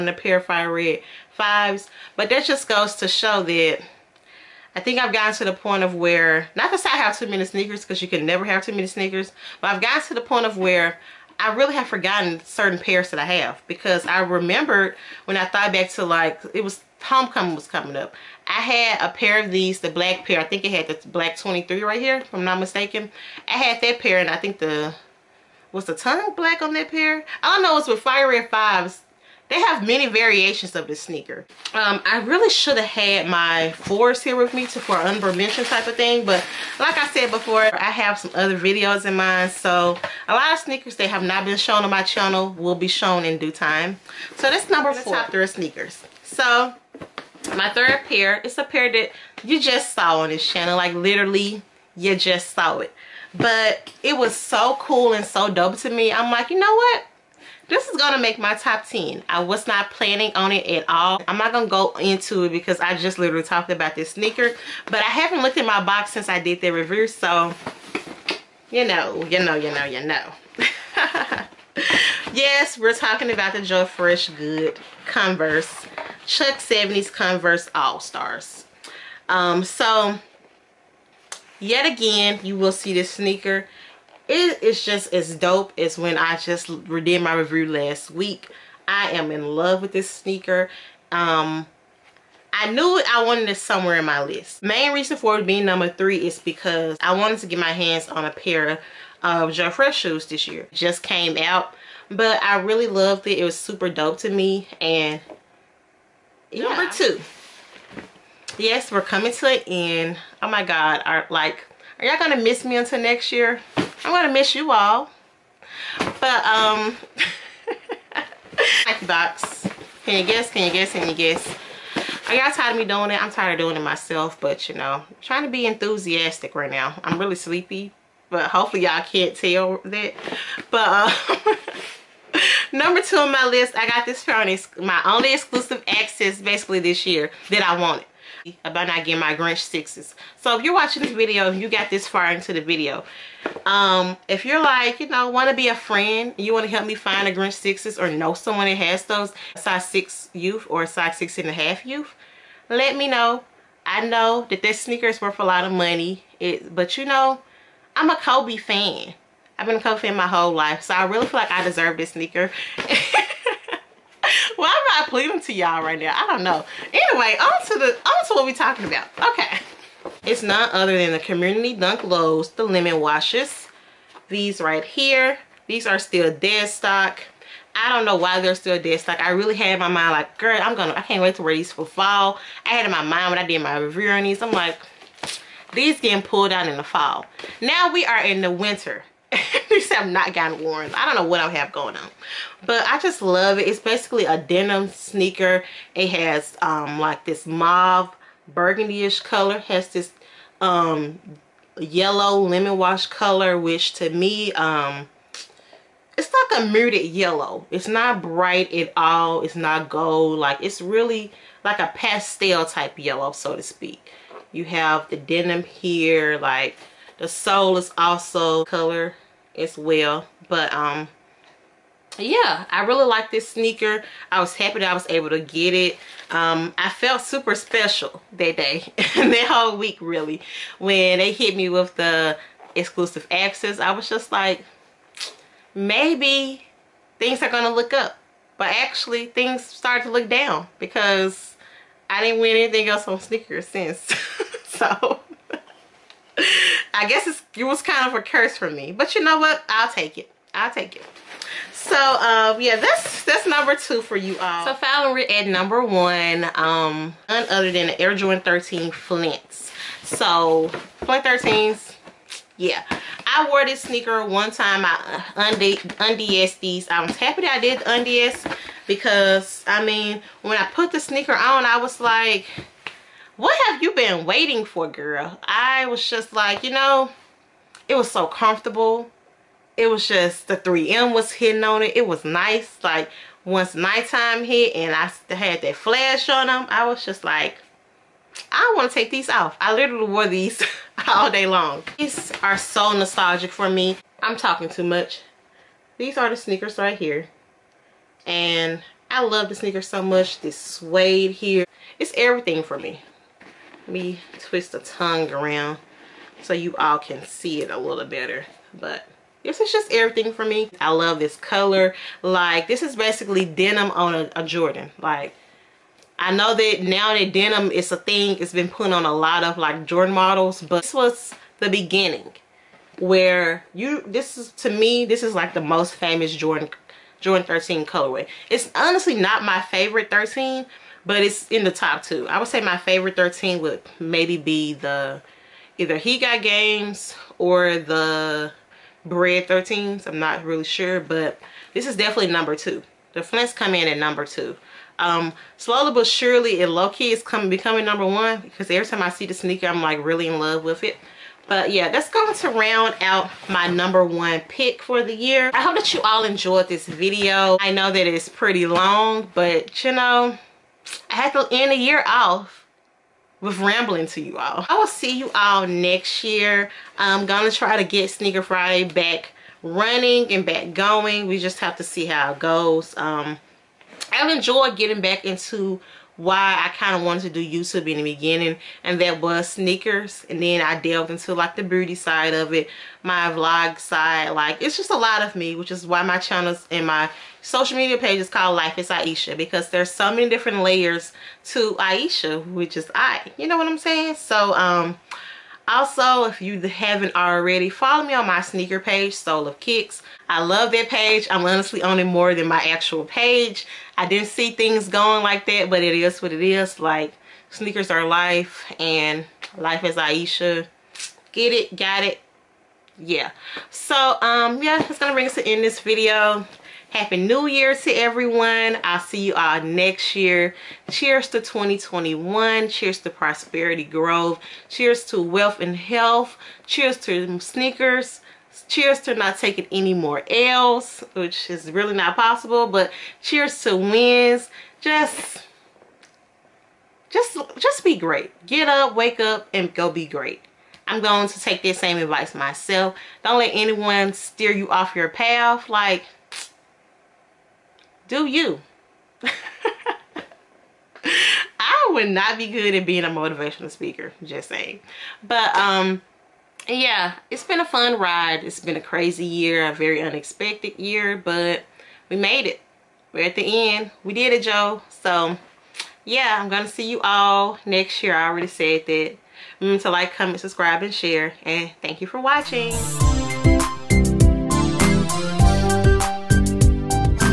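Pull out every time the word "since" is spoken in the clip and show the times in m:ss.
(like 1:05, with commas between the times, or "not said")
1:06, 4:03.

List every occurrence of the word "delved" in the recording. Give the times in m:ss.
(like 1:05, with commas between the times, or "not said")
6:20.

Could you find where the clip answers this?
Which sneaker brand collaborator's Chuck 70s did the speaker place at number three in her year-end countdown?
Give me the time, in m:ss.
1:13.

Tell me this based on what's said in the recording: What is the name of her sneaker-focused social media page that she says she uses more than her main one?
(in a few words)
Sole of Kicks.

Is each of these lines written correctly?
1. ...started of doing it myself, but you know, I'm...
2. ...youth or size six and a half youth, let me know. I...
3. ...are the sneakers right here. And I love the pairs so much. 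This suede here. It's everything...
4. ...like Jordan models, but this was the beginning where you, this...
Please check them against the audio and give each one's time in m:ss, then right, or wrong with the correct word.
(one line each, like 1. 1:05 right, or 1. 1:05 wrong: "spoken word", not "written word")
1. 2:03 wrong: "tired", not "started"
2. 2:30 right
3. 4:56 wrong: "sneakers", not "pairs"
4. 5:19 right.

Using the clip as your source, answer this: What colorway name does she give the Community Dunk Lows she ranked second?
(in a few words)
Lemon Washes.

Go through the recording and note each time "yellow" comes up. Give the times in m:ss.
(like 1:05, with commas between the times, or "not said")
3:21, 3:27, 3:32.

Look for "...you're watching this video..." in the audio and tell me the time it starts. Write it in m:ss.
2:20.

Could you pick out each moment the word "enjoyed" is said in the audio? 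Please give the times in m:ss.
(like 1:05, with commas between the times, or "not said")
5:56, 6:14.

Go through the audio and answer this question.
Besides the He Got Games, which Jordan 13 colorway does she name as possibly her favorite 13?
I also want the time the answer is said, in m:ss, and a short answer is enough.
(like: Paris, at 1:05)
Bred 13s, at 5:39.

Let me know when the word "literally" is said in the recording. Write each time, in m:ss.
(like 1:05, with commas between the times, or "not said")
0:50, 1:03, 4:49.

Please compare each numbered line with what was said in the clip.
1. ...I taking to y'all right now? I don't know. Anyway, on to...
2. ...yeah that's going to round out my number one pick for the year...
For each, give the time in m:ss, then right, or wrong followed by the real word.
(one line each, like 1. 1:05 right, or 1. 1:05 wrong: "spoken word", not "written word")
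1. 2:45 wrong: "pleading", not "taking"
2. 5:51 right.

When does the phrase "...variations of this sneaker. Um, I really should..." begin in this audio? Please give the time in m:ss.
0:30.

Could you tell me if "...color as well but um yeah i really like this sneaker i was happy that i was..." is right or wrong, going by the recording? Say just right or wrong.
right.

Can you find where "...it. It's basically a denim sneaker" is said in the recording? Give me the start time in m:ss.
3:13.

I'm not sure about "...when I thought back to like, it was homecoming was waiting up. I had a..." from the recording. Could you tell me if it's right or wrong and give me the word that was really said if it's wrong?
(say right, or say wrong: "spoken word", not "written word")
wrong: "coming", not "waiting".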